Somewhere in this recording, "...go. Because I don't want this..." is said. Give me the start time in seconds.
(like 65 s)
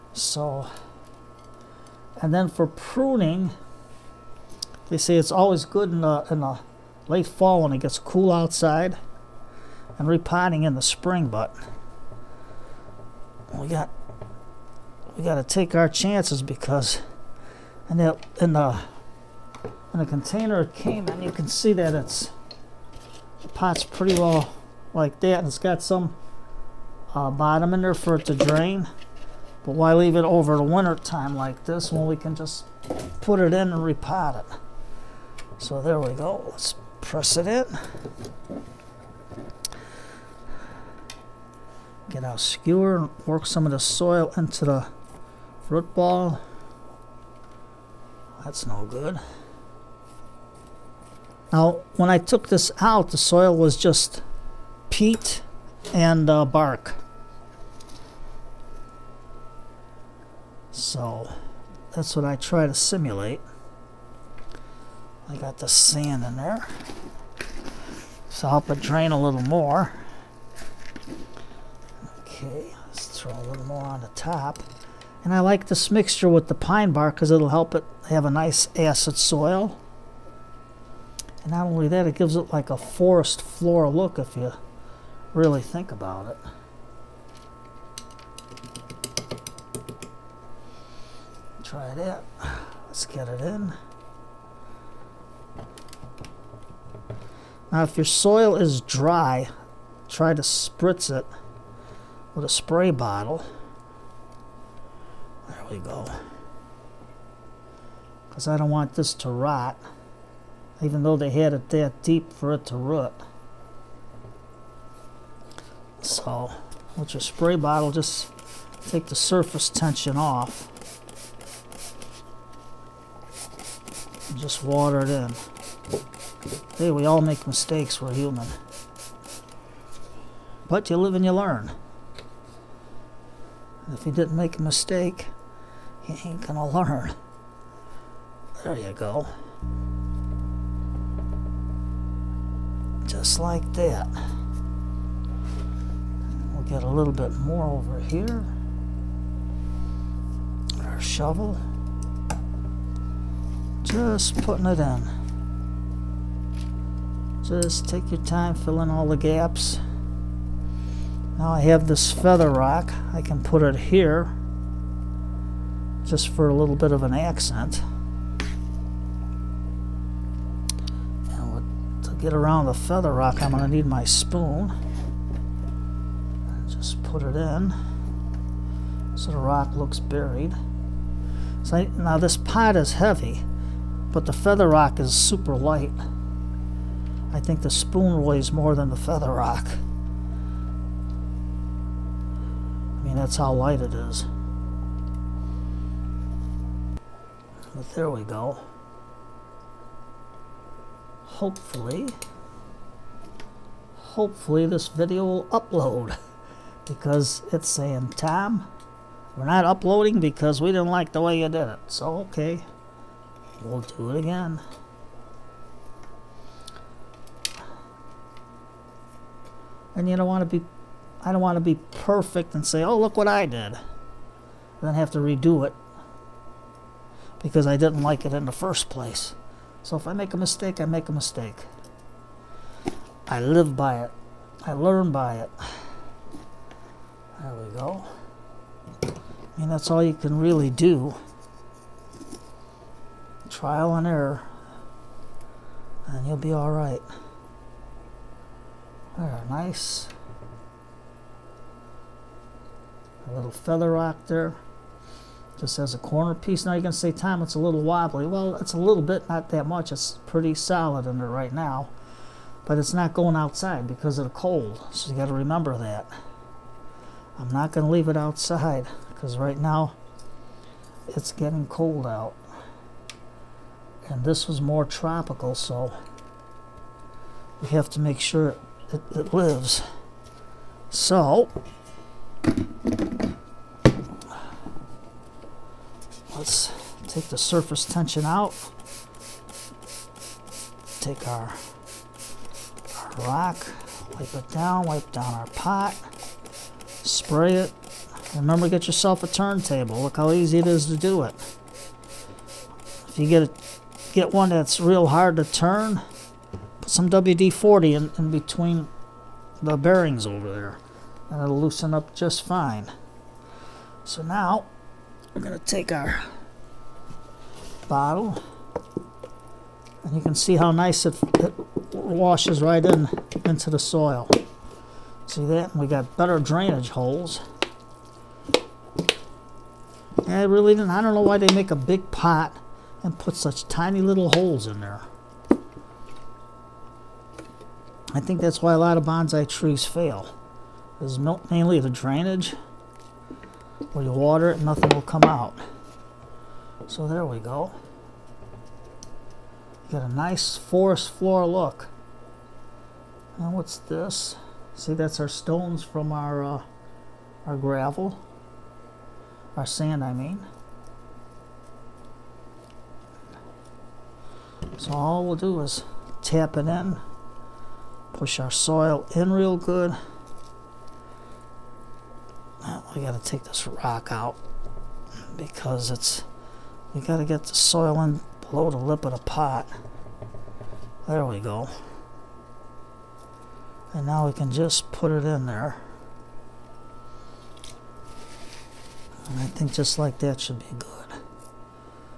105 s.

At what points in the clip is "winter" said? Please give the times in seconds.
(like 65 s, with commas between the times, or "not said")
30 s.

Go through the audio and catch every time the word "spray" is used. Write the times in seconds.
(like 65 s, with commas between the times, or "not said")
102 s, 117 s, 297 s.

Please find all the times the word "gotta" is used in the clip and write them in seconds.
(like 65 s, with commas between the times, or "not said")
373 s, 377 s.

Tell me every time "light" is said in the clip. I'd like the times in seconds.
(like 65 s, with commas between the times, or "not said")
185 s, 193 s.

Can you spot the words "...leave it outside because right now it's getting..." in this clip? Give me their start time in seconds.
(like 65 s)
267 s.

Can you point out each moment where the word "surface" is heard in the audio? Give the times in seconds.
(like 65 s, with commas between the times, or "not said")
119 s, 287 s.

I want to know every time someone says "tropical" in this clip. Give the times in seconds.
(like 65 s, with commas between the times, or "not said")
274 s.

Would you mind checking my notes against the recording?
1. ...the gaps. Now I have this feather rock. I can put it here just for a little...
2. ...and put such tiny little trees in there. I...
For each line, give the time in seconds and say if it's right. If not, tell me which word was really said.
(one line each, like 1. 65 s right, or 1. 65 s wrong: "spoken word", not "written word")
1. 159 s right
2. 333 s wrong: "holes", not "trees".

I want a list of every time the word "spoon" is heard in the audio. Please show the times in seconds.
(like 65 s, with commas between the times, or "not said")
174 s, 187 s.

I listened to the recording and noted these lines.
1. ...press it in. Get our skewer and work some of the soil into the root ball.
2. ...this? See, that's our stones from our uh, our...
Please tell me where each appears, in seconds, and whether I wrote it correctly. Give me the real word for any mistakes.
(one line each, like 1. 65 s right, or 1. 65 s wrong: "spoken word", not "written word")
1. 37 s right
2. 353 s right.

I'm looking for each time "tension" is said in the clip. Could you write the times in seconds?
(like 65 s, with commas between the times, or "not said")
119 s, 287 s.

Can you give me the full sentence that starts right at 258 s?
Well, it's a little bit, not that much.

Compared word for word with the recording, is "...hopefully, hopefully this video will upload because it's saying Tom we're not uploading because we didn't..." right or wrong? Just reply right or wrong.
right.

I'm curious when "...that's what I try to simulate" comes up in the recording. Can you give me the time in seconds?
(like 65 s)
61 s.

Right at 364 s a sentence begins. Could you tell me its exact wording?
So all we'll do is tap it in, push our soil in real good.